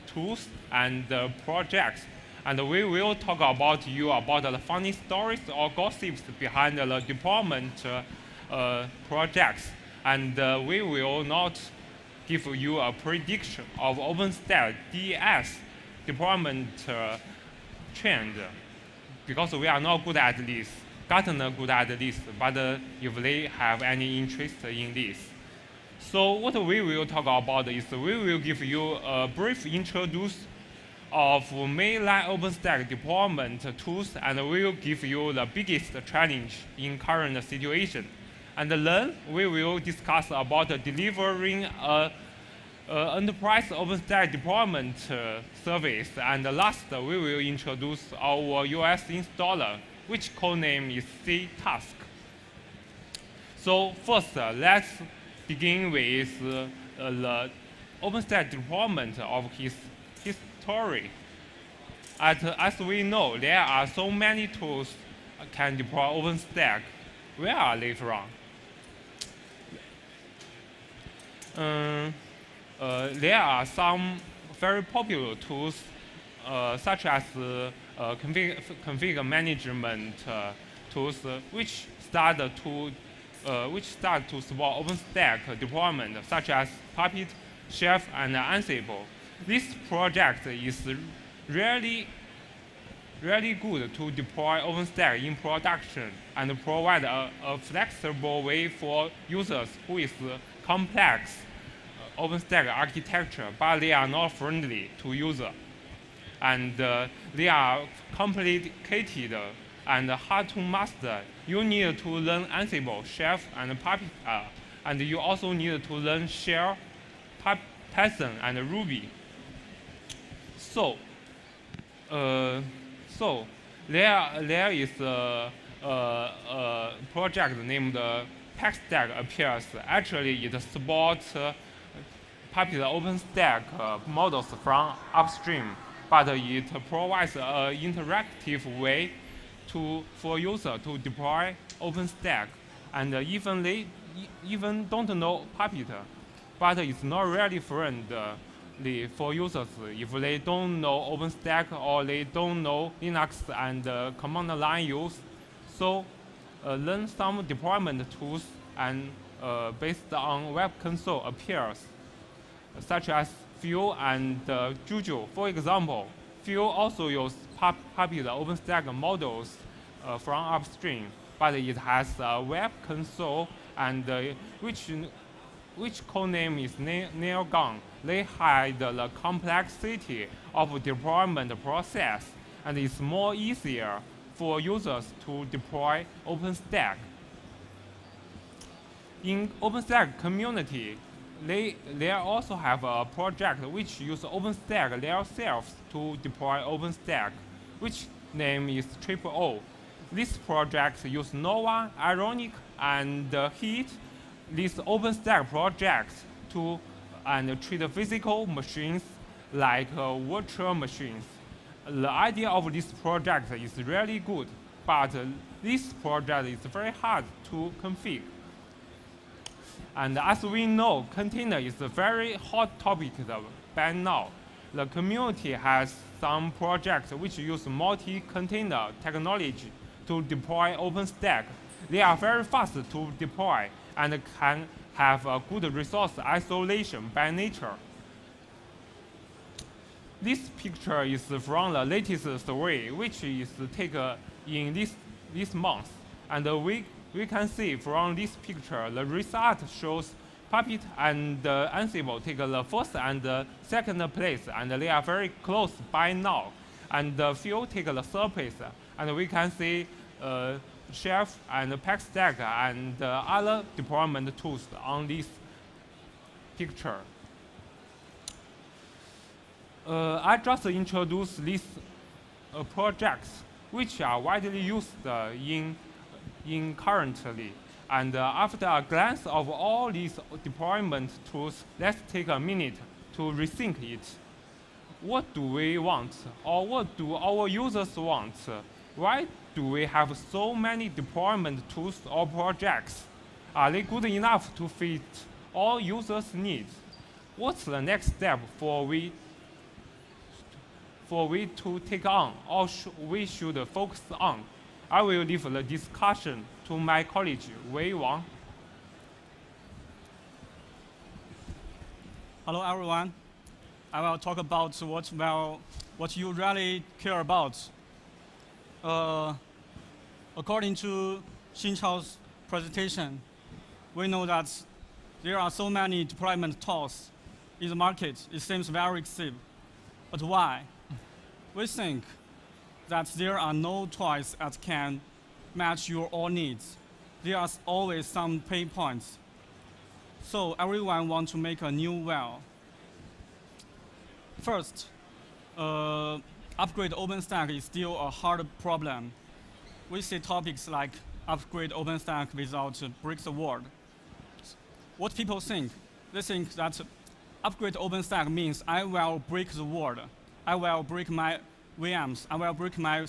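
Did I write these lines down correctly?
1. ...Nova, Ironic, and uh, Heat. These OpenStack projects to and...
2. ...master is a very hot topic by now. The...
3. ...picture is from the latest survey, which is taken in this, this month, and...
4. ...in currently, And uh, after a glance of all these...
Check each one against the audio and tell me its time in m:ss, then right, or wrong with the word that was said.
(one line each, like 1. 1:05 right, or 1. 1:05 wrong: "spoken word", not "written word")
1. 3:21 right
2. 3:41 wrong: "container", not "master"
3. 4:00 right
4. 4:35 right.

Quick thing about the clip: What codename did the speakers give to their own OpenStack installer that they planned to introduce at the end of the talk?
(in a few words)
C task.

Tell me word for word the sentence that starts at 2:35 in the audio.
So uh, learn some deployment tools and uh, based on web console appears, such as Fuel and uh, Juju.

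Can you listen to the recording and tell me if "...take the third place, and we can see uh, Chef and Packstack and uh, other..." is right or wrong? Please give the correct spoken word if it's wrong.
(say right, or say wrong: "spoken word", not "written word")
right.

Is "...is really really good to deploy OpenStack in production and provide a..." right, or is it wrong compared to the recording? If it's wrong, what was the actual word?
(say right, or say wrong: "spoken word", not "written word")
right.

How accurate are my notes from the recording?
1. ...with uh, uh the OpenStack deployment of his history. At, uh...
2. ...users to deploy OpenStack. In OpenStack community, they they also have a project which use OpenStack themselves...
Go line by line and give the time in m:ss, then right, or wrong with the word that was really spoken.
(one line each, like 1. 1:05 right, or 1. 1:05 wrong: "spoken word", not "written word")
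1. 0:55 right
2. 3:04 right.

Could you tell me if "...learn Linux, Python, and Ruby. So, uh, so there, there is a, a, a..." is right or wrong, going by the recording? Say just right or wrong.
wrong.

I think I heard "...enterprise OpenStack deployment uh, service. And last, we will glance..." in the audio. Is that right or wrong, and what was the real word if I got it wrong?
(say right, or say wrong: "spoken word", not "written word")
wrong: "introduce", not "glance".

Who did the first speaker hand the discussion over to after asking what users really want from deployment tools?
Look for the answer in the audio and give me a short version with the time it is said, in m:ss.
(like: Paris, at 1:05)
Wei Wang, at 5:07.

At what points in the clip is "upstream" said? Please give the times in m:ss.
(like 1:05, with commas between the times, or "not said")
2:15, 2:50.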